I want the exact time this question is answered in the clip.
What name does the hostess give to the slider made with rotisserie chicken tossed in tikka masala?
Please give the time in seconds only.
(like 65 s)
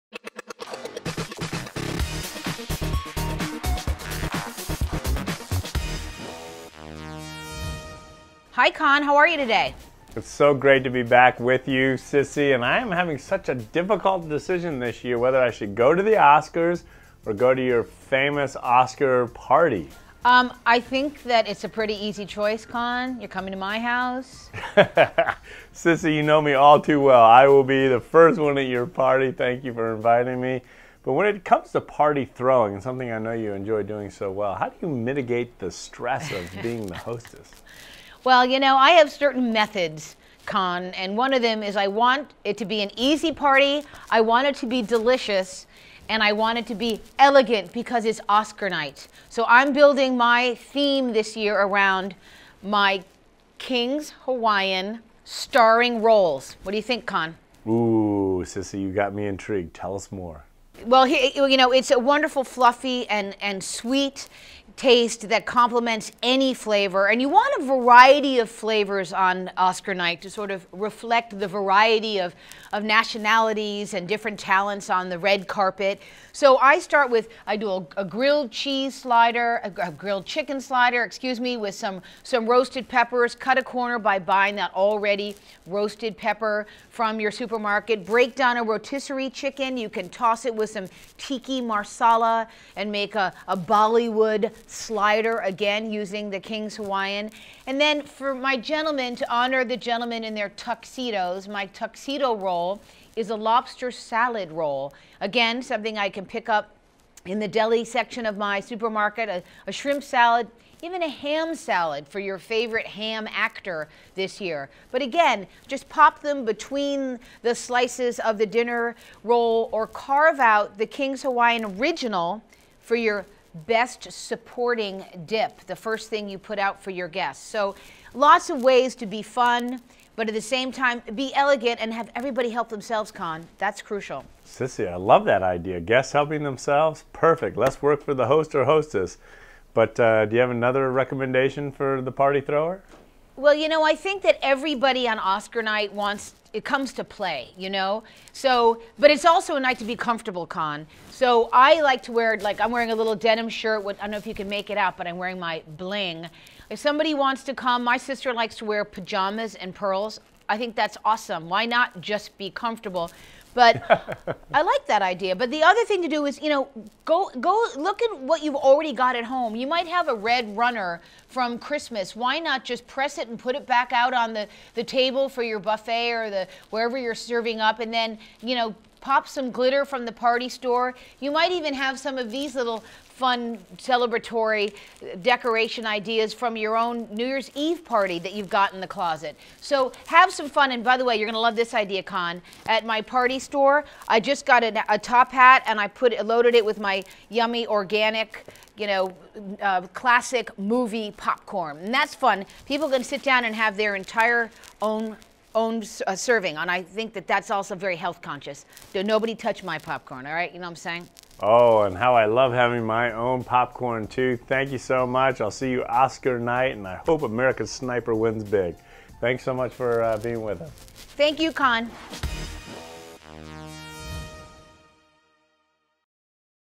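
93 s.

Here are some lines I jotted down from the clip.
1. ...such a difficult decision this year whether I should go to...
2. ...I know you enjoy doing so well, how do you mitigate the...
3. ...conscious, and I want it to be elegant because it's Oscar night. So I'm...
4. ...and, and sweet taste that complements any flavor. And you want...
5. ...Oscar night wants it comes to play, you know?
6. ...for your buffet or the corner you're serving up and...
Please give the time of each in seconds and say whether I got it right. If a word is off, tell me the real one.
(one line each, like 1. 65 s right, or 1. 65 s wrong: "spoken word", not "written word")
1. 13 s right
2. 33 s right
3. 44 s wrong: "delicious", not "conscious"
4. 63 s right
5. 145 s right
6. 175 s wrong: "wherever", not "corner".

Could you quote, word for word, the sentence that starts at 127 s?
So lots of ways to be fun, but at the same time, be elegant and have everybody help themselves, Conn.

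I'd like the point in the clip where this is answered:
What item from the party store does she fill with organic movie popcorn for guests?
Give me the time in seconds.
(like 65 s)
194 s.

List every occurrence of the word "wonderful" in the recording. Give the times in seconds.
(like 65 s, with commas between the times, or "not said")
61 s.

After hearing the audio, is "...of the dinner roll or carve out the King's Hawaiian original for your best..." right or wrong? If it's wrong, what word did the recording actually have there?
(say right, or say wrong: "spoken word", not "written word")
right.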